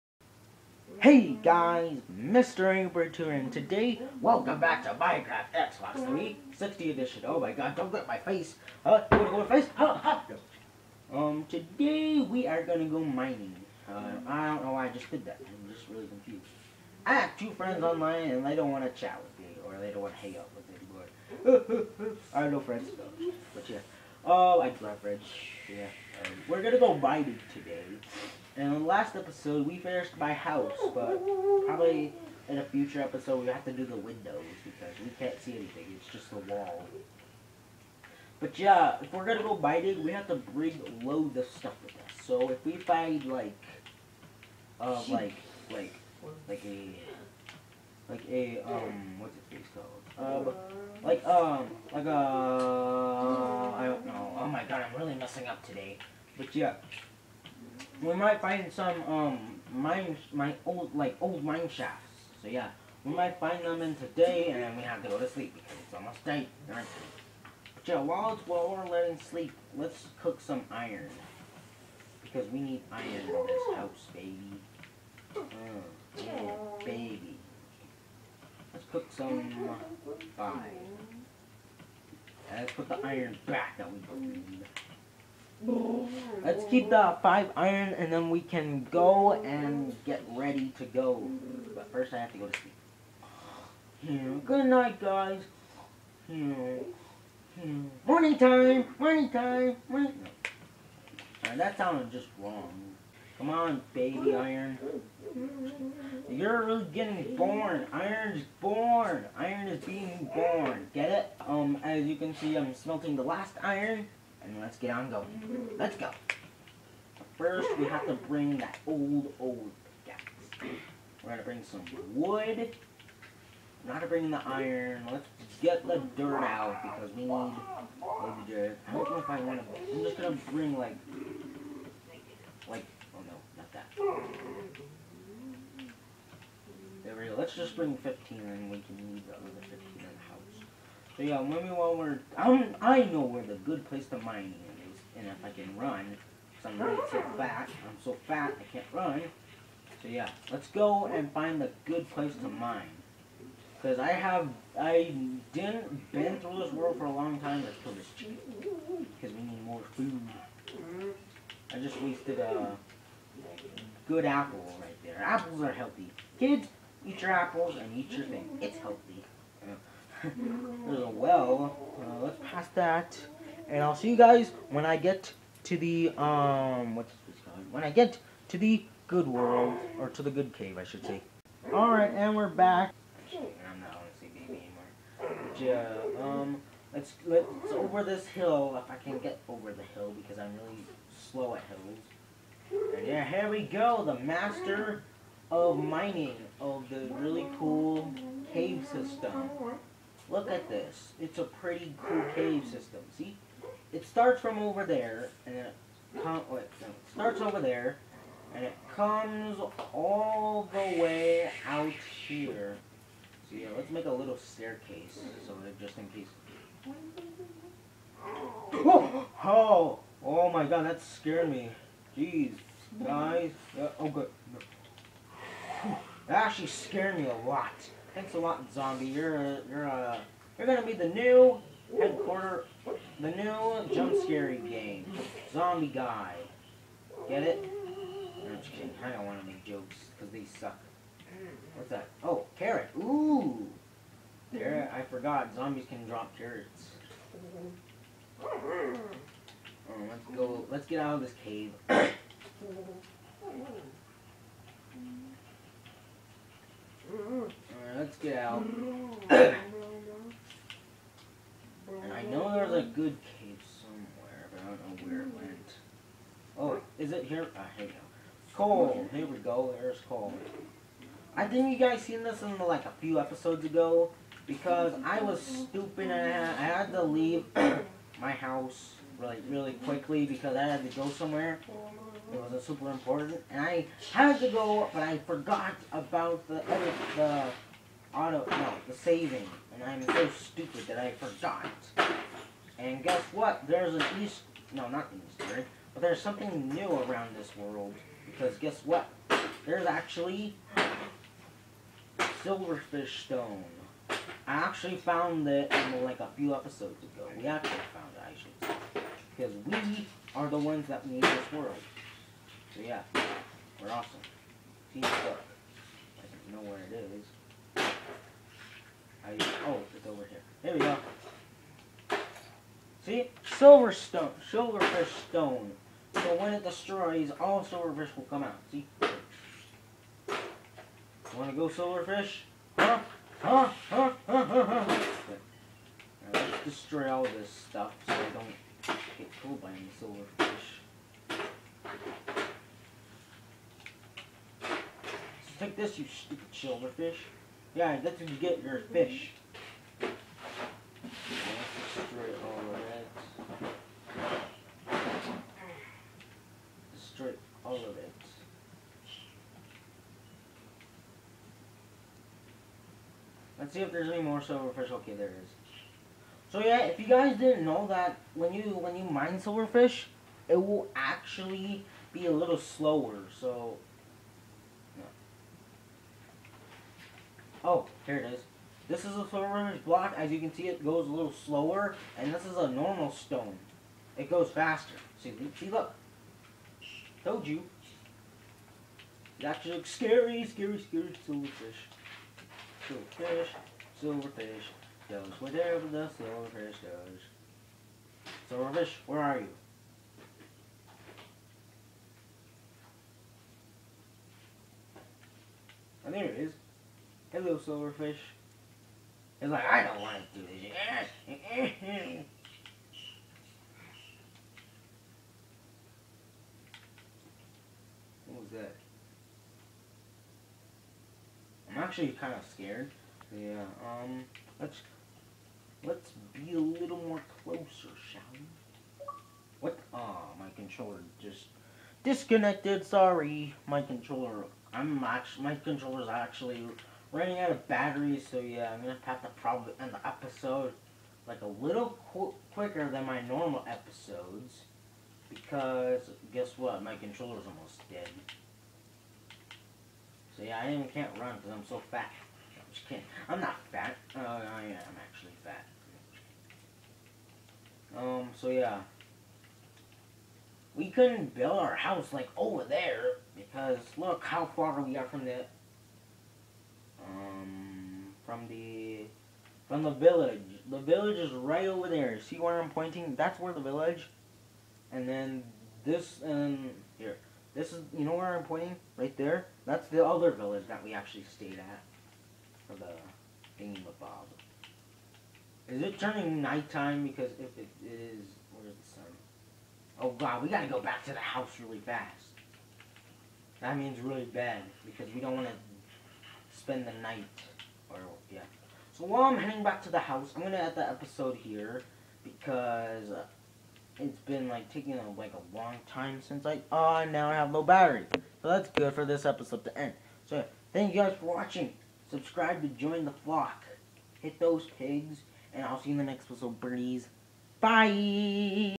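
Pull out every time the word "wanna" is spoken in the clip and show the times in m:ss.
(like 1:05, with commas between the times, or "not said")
0:09, 5:31.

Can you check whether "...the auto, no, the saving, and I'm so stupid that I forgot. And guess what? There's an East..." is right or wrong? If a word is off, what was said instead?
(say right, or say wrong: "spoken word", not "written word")
right.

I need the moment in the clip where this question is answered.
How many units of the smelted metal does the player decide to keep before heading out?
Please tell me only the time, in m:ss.
1:27.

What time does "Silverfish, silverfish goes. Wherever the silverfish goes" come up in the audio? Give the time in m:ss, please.
6:32.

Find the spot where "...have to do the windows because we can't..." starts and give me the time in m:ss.
0:33.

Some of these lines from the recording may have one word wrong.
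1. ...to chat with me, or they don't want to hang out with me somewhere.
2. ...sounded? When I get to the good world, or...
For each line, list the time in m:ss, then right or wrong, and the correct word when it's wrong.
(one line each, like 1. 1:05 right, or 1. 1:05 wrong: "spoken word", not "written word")
1. 0:18 wrong: "anymore", not "somewhere"
2. 2:57 wrong: "called", not "sounded".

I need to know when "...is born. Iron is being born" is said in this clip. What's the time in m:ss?
1:48.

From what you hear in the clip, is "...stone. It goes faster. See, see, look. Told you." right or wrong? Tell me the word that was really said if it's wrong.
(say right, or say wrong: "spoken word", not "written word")
right.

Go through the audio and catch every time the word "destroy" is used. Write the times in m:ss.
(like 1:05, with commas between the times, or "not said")
5:26, 5:36, 5:51, 5:56.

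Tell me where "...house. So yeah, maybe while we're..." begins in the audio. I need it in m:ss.
2:20.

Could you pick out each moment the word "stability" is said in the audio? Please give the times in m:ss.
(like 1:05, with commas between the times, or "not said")
not said.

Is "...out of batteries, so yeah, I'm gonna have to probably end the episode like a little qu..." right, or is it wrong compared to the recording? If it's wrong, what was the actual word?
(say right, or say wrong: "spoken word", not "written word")
right.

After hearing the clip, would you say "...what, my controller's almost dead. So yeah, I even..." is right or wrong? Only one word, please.
right.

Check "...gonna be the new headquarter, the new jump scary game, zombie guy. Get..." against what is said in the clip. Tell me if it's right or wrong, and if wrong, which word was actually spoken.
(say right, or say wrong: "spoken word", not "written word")
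right.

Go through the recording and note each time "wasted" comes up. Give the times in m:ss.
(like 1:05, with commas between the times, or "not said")
2:42.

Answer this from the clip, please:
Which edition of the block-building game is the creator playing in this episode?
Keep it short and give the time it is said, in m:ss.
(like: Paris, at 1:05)
Xbox 360 Edition, at 0:05.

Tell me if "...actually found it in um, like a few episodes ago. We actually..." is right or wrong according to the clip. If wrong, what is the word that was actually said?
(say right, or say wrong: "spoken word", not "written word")
right.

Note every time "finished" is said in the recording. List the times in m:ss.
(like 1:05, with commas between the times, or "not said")
0:29.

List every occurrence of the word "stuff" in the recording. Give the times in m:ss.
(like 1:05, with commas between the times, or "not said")
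0:41, 5:37.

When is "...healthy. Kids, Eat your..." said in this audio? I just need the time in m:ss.
2:45.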